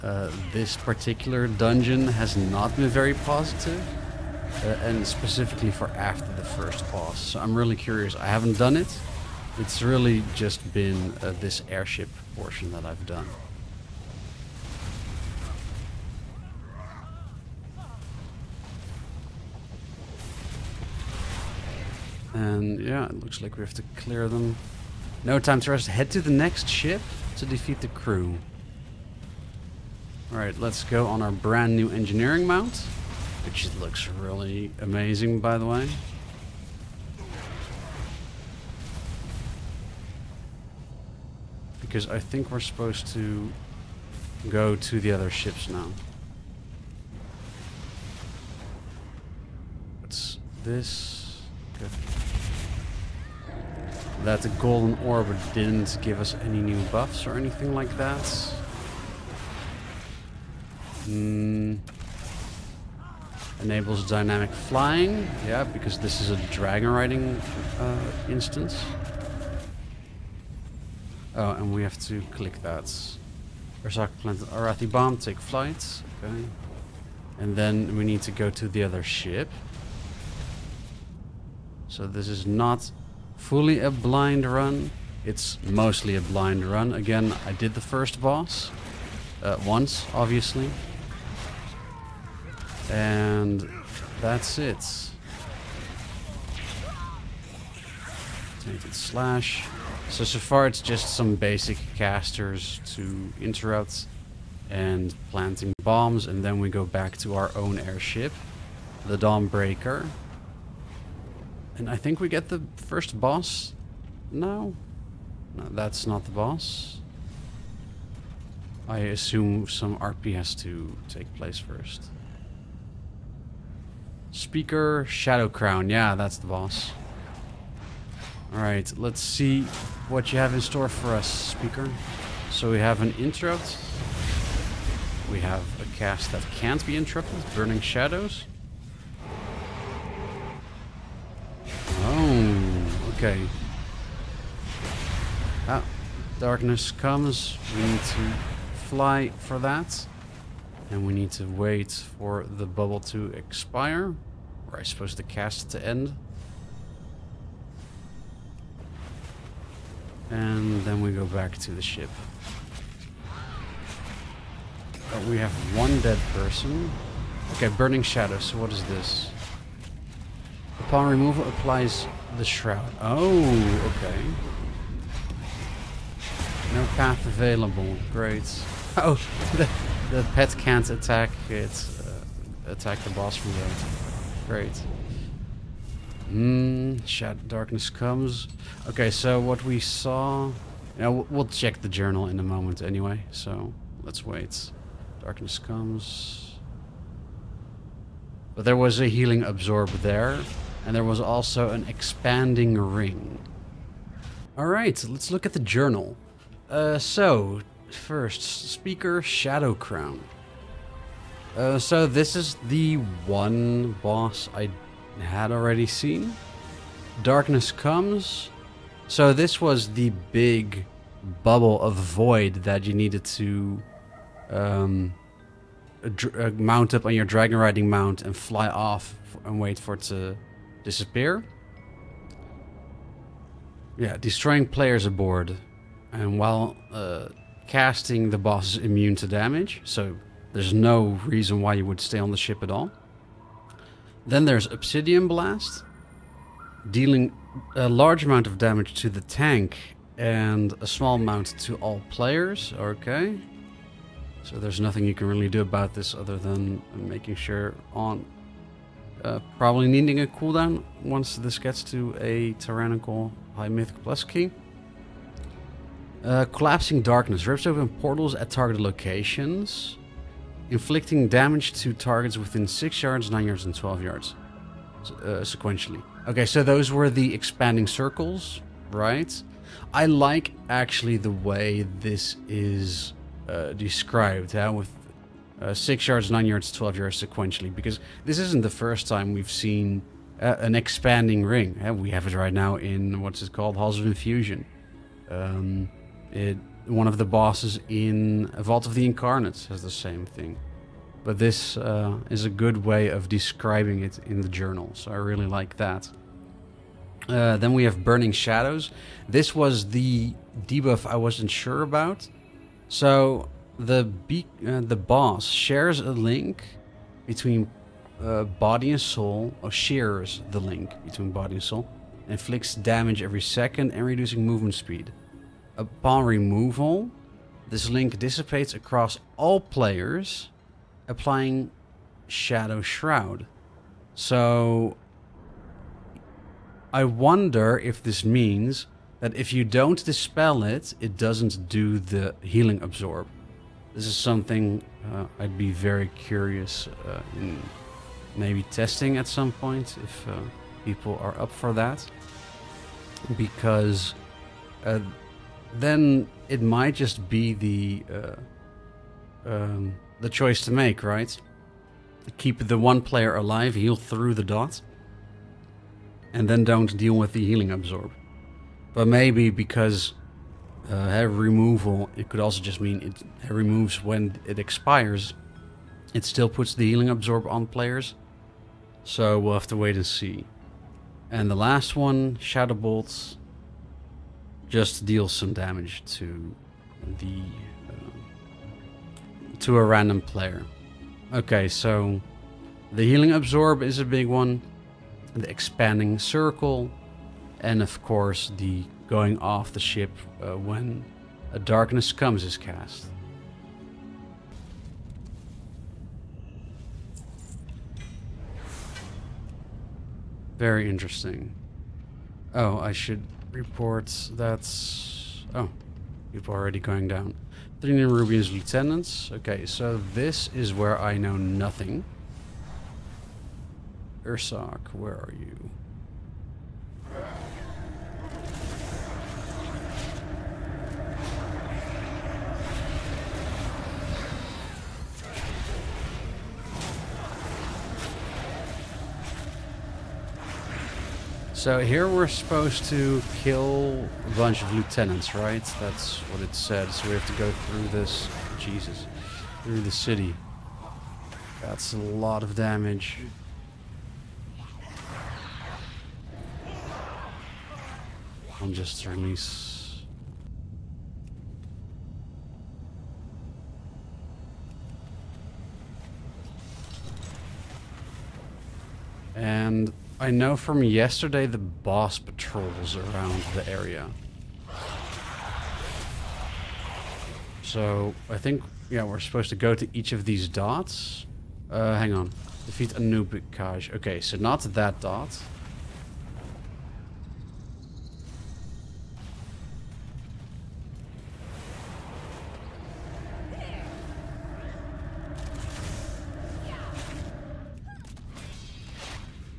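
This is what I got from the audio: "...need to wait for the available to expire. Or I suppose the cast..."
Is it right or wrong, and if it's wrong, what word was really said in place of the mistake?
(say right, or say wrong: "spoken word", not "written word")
wrong: "bubble", not "available".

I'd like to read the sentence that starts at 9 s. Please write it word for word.
It's really just been uh, this airship portion that I've done.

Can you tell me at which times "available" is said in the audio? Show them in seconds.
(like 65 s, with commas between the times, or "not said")
177 s.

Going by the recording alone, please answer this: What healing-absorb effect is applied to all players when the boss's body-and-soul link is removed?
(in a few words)
Shadow Shroud.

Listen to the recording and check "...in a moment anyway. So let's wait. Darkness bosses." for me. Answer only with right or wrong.
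wrong.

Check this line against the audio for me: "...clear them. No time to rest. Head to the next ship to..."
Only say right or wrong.
right.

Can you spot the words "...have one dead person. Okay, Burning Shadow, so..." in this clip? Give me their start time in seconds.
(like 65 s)
165 s.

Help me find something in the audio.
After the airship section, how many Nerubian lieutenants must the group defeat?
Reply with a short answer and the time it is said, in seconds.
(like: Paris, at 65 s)
3, at 417 s.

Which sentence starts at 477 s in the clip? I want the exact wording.
So, I think, yeah, we're supposed to go to each of these dots.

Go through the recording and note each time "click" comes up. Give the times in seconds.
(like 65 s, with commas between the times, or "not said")
72 s.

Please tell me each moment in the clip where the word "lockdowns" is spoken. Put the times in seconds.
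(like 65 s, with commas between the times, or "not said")
not said.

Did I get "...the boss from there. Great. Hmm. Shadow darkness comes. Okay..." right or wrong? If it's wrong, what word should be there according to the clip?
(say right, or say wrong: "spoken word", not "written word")
right.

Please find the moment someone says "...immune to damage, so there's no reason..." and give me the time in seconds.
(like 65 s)
238 s.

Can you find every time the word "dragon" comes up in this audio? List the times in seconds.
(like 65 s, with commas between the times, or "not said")
66 s, 227 s.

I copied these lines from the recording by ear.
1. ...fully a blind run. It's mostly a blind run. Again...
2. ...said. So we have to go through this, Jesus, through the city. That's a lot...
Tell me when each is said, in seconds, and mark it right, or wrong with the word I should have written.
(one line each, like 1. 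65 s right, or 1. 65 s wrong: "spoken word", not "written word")
1. 83 s right
2. 446 s right.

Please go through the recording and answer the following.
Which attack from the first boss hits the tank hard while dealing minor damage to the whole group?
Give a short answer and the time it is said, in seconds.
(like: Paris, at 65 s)
Obsidian Blast, at 244 s.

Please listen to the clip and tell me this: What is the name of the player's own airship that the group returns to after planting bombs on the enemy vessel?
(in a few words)
Dawnbreaker.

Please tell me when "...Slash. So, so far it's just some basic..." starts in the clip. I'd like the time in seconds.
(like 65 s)
98 s.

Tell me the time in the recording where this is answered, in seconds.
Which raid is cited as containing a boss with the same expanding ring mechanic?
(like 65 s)
298 s.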